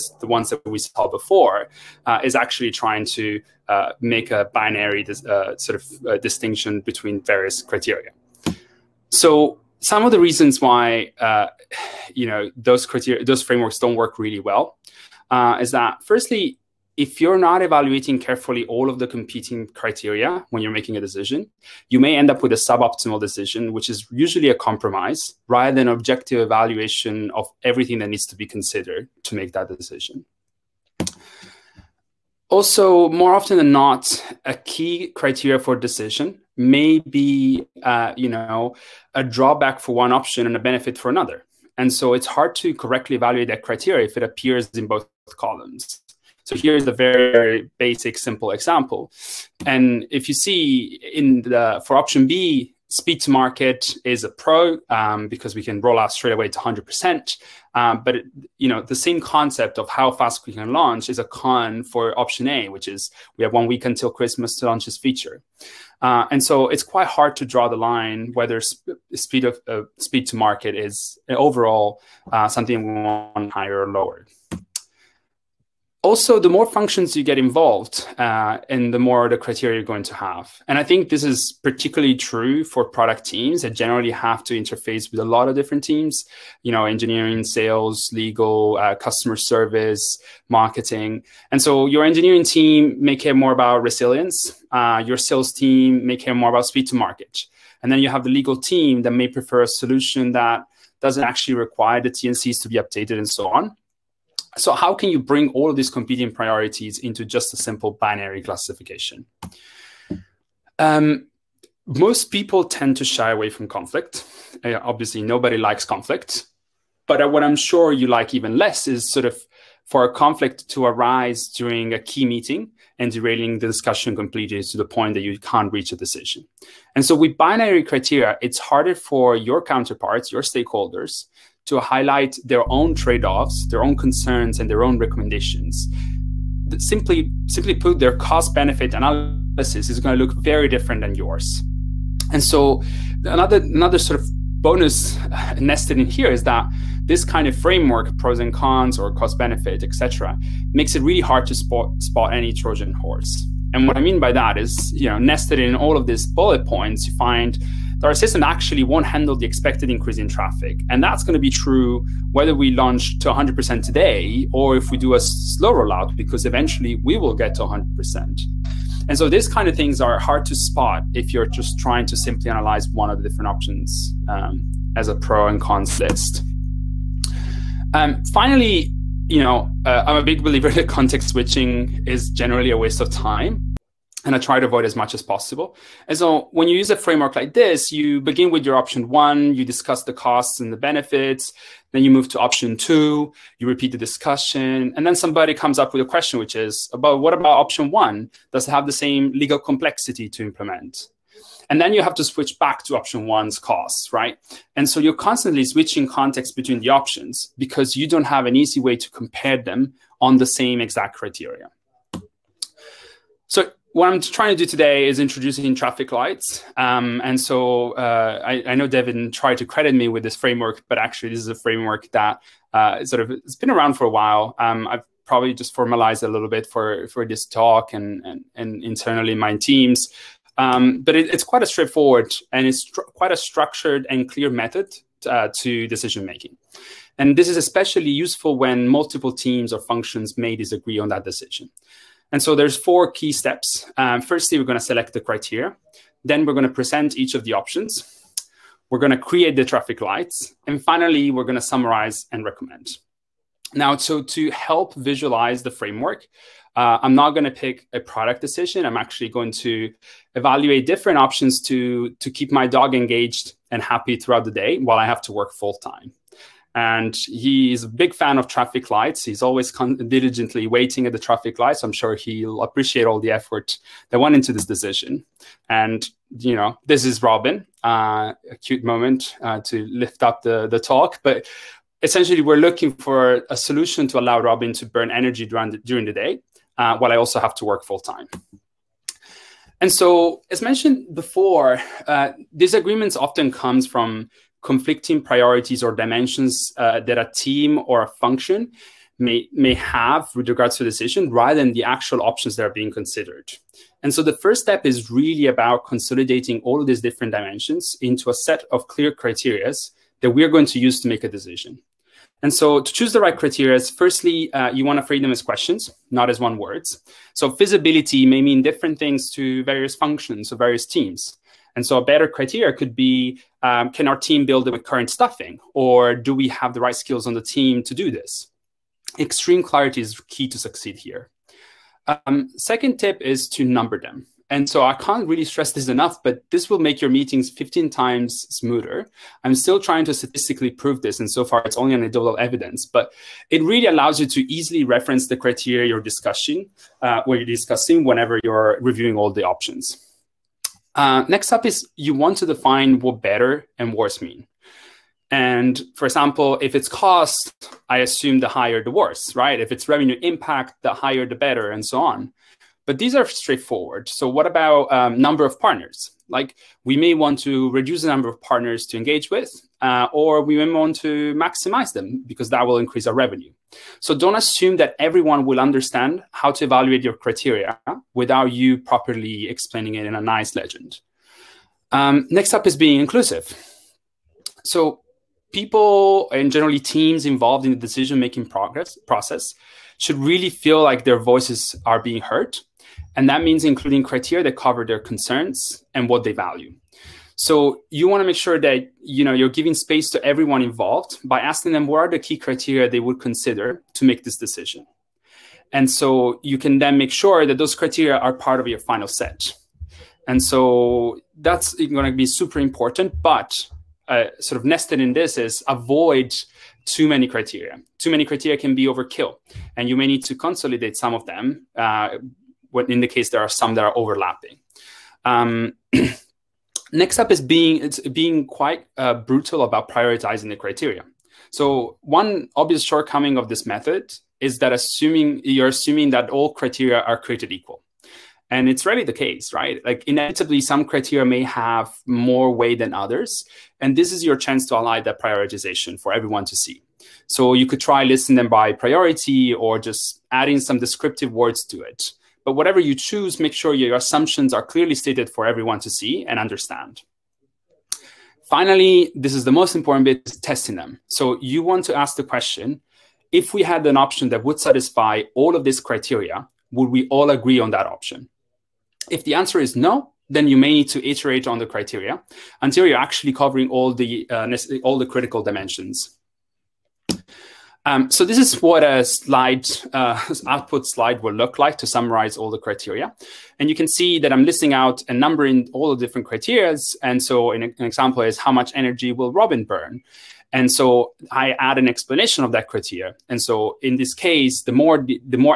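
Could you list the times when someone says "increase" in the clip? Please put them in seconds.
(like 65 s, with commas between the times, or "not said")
159 s, 372 s.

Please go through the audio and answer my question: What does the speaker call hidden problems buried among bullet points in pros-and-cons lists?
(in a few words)
Trojan horse.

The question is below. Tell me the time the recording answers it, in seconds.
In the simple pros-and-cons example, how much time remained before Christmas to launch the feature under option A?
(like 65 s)
63 s.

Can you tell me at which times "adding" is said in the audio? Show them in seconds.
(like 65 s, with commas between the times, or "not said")
450 s.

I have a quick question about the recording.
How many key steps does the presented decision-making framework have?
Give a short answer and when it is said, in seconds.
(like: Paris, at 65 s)
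4, at 242 s.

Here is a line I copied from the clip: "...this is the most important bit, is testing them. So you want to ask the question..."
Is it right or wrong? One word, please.
right.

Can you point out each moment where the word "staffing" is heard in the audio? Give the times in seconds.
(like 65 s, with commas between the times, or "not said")
325 s.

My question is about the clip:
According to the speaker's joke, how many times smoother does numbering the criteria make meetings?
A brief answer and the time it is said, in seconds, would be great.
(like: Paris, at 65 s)
15, at 337 s.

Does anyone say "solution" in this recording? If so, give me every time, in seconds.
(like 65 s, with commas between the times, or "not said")
99 s, 283 s.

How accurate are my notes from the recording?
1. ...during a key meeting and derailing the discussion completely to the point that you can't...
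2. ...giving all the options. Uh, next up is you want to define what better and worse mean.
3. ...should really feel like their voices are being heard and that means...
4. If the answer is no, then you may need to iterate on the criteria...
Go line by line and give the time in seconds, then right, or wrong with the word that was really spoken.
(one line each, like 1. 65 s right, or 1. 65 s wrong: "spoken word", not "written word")
1. 121 s right
2. 348 s wrong: "reviewing", not "giving"
3. 389 s right
4. 469 s right.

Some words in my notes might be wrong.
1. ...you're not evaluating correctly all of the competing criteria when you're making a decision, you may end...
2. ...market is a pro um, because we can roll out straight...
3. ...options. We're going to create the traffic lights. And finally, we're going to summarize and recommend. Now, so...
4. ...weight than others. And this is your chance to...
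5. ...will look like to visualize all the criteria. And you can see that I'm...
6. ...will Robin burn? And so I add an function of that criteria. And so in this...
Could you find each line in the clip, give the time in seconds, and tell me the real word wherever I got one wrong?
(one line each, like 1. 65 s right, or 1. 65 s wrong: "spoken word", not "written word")
1. 17 s wrong: "carefully", not "correctly"
2. 53 s right
3. 247 s right
4. 442 s right
5. 481 s wrong: "summarize", not "visualize"
6. 489 s wrong: "explanation", not "function".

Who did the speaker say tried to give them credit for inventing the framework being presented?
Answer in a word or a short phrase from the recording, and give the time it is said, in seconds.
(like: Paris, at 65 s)
Devin, at 218 s.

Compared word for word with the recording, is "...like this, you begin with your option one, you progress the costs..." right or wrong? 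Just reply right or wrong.
wrong.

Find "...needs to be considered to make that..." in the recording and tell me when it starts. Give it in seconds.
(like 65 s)
28 s.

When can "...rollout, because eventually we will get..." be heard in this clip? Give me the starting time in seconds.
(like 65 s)
165 s.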